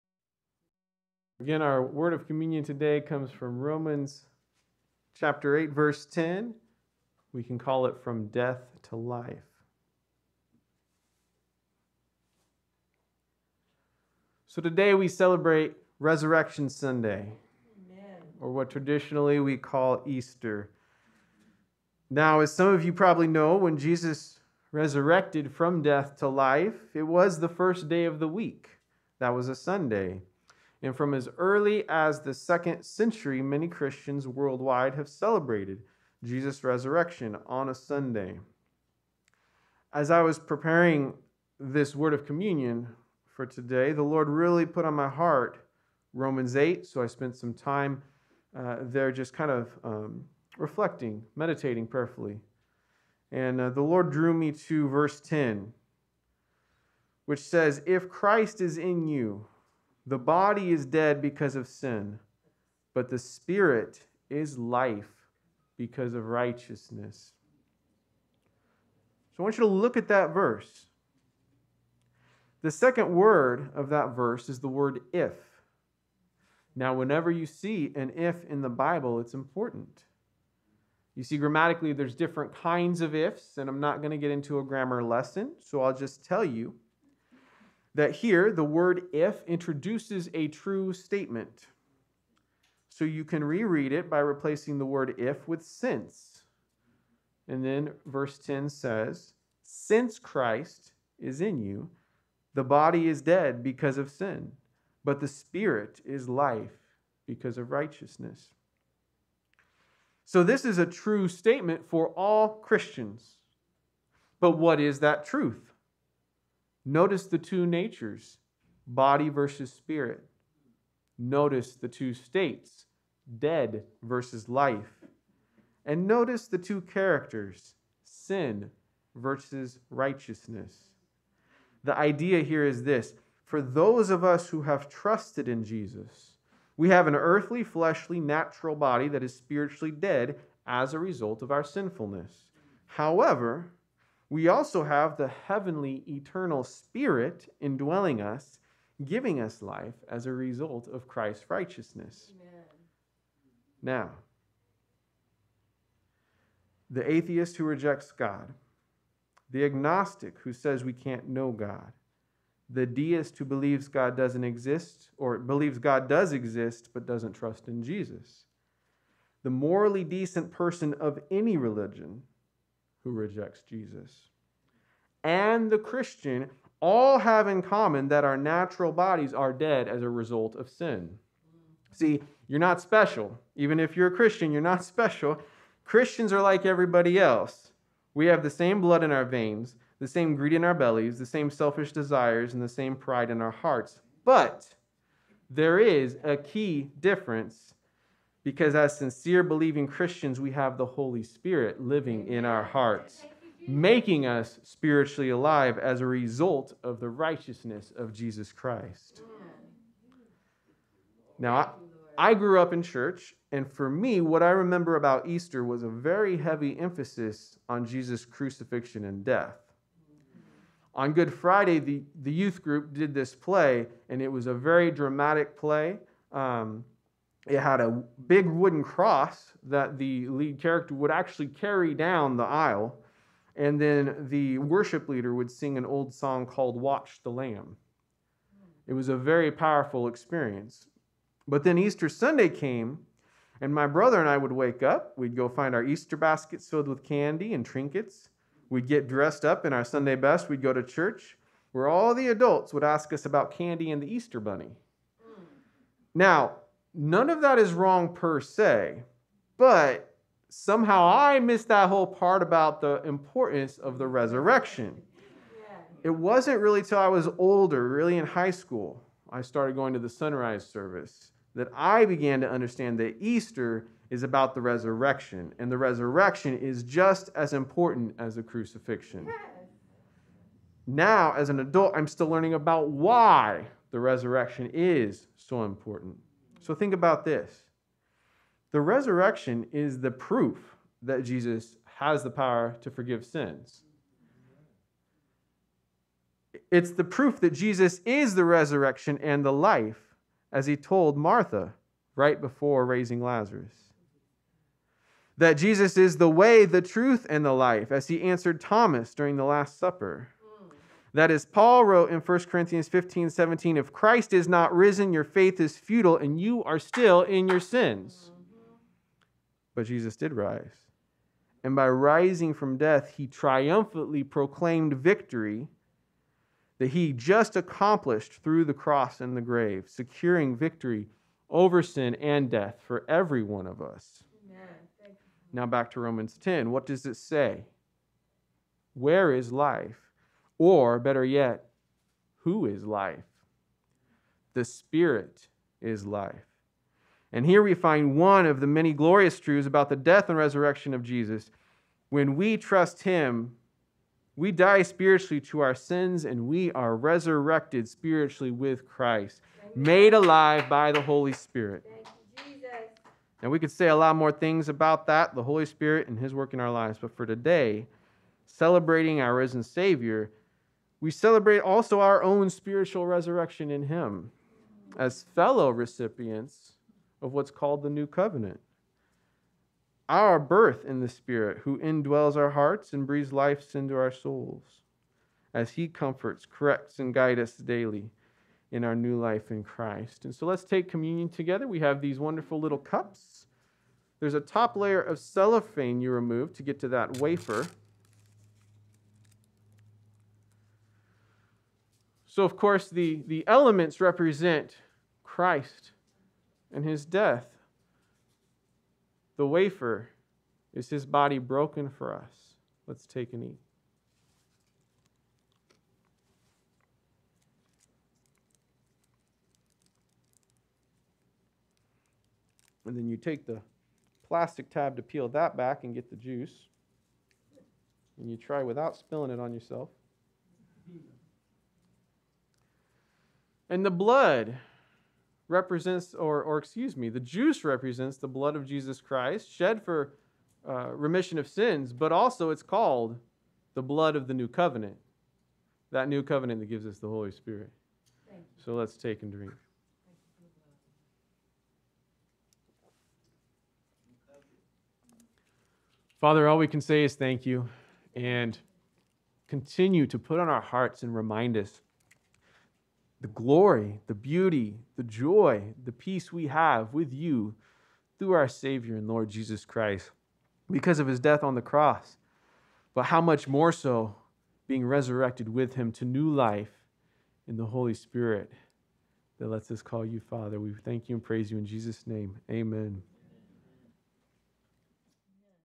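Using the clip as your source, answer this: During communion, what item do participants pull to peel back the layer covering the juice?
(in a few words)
plastic tab.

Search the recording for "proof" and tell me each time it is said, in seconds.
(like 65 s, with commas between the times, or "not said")
290 s, 297 s.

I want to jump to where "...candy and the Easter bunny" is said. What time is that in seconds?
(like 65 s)
253 s.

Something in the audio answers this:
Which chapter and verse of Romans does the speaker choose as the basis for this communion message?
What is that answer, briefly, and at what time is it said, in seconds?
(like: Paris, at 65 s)
Romans 8:10, at 3 s.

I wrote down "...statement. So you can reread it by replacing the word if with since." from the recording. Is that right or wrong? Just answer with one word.
right.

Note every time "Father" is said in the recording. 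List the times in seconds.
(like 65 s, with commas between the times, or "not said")
456 s, 480 s.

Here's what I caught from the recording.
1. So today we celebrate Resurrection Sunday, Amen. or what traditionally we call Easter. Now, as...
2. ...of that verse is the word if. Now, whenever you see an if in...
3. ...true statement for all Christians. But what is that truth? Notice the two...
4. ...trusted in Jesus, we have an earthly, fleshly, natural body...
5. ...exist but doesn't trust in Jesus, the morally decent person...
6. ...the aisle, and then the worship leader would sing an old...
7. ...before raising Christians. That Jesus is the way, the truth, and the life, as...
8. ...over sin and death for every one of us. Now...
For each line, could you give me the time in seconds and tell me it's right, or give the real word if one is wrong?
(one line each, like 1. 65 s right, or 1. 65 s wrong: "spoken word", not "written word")
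1. 14 s right
2. 73 s right
3. 110 s right
4. 134 s right
5. 166 s right
6. 232 s right
7. 302 s wrong: "Lazarus", not "Christians"
8. 331 s right.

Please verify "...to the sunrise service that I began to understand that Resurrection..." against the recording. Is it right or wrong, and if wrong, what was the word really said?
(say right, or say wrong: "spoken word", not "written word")
wrong: "Easter", not "Resurrection".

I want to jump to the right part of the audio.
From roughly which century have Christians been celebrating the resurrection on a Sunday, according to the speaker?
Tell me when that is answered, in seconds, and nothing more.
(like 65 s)
32 s.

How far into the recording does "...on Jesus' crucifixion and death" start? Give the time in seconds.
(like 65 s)
217 s.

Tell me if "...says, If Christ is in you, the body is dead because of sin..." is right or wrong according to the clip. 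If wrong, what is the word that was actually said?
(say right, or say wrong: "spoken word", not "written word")
right.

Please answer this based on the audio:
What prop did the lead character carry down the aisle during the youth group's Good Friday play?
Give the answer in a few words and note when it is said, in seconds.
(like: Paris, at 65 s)
big wooden cross, at 228 s.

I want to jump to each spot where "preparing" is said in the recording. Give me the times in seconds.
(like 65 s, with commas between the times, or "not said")
40 s.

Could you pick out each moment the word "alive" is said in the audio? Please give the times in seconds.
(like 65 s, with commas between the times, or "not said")
205 s, 360 s.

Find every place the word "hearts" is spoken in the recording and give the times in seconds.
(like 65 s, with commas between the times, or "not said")
45 s, 193 s, 202 s, 382 s, 460 s.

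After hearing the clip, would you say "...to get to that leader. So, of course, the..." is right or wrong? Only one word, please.
wrong.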